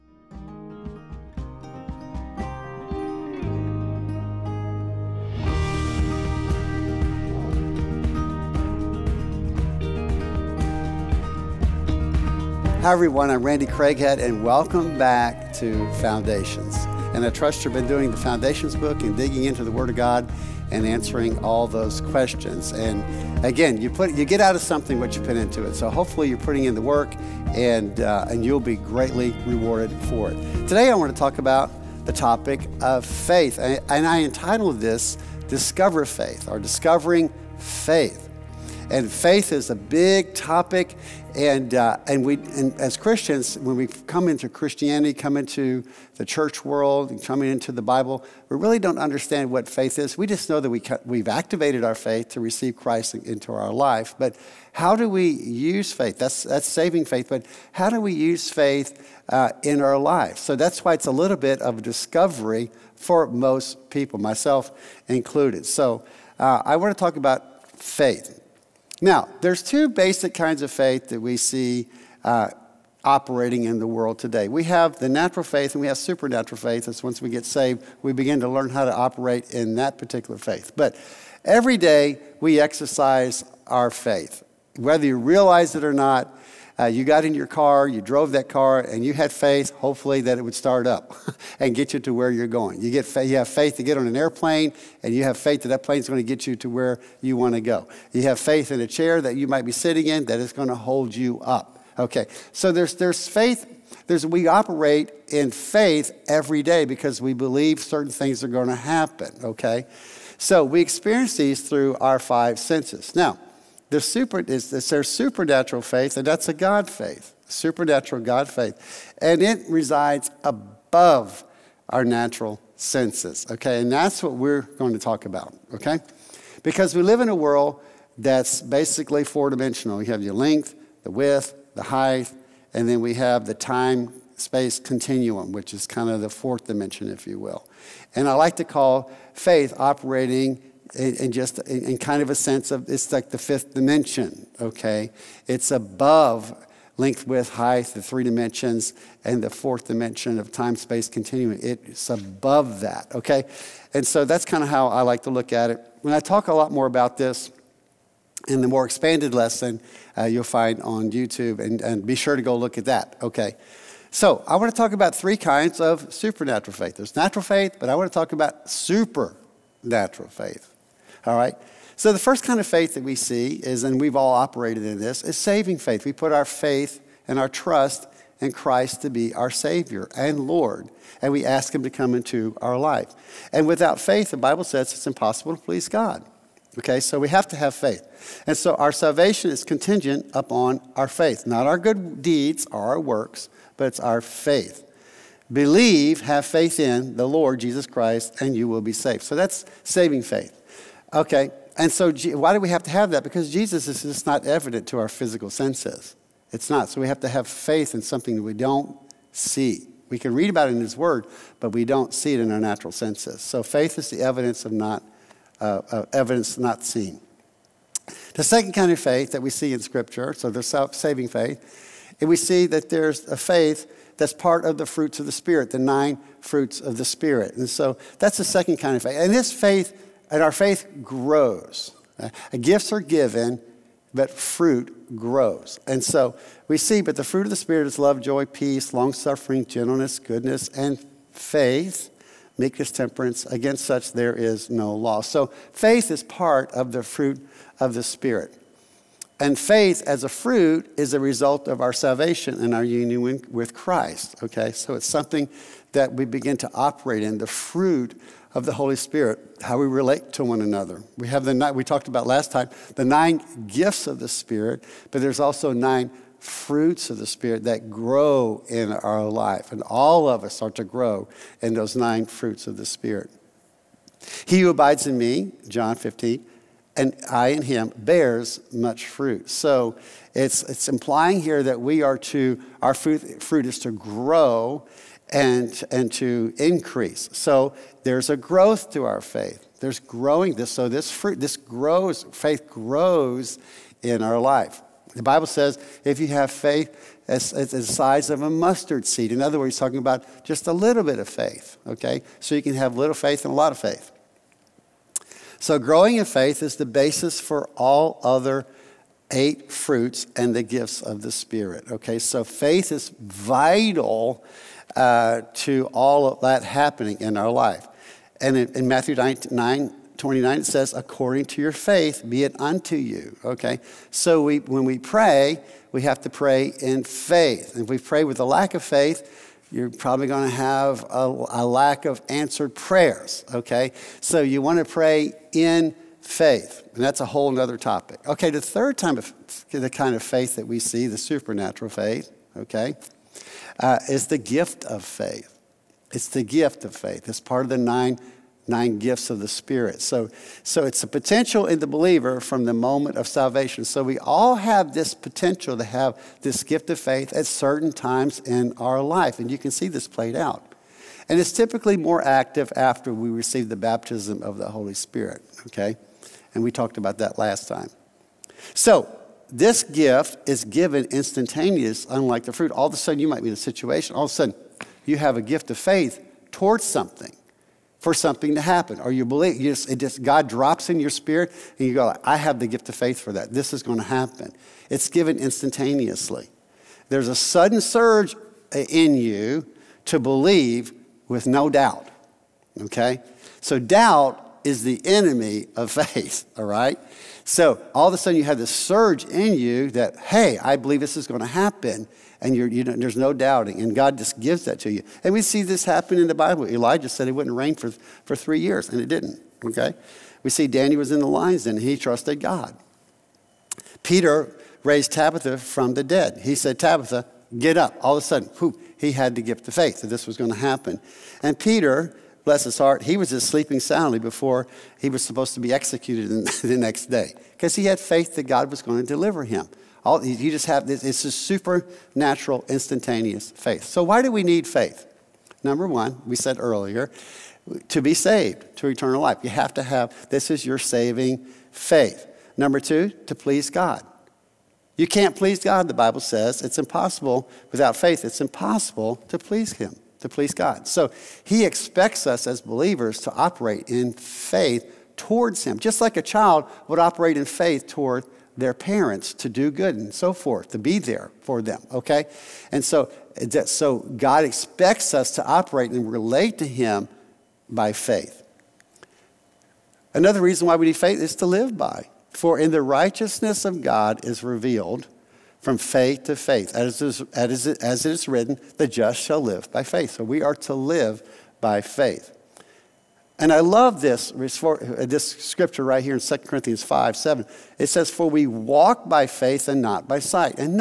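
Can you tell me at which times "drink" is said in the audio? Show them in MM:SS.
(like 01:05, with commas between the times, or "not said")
not said.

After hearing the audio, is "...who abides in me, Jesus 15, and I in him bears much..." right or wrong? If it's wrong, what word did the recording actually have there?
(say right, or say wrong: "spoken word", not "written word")
wrong: "John", not "Jesus".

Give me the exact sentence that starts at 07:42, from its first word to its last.
And so, so God expects us to operate and relate to him by faith.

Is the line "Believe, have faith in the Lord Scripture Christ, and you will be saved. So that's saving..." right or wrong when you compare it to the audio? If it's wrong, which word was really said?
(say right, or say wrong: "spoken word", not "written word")
wrong: "Jesus", not "Scripture".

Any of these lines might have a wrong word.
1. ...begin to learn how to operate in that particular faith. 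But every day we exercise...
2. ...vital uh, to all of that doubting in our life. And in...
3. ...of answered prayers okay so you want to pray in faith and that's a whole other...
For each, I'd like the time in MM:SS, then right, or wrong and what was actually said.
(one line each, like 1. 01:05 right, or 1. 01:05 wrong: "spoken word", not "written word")
1. 01:18 right
2. 05:13 wrong: "happening", not "doubting"
3. 05:32 right.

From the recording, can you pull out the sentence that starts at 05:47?
It's part of the nine, nine gifts of the Spirit.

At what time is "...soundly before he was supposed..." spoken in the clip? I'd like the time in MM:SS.
07:03.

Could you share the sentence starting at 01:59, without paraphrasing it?
And it resides above our natural senses, okay?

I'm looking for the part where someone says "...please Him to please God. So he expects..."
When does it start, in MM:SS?
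07:29.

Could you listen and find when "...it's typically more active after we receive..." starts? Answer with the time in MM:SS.
06:01.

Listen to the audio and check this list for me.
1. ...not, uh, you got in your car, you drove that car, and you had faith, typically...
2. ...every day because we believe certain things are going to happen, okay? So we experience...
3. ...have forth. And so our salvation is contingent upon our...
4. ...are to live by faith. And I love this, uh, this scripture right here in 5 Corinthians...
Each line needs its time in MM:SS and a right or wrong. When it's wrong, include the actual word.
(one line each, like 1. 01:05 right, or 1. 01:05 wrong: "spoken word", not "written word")
1. 01:25 wrong: "hopefully", not "typically"
2. 01:46 right
3. 03:07 wrong: "faith", not "forth"
4. 08:00 wrong: "2", not "5".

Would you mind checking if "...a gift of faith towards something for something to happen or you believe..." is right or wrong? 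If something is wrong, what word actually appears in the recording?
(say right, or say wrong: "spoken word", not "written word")
right.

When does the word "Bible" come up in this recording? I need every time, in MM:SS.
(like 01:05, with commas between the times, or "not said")
00:47, 03:04, 04:55, 06:46, 07:25.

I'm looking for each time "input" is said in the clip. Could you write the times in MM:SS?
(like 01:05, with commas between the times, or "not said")
not said.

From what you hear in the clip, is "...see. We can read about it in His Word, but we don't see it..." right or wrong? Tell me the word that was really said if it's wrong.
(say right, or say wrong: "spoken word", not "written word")
right.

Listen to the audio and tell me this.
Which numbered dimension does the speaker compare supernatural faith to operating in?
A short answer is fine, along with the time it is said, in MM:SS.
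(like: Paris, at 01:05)
fifth dimension, at 02:23.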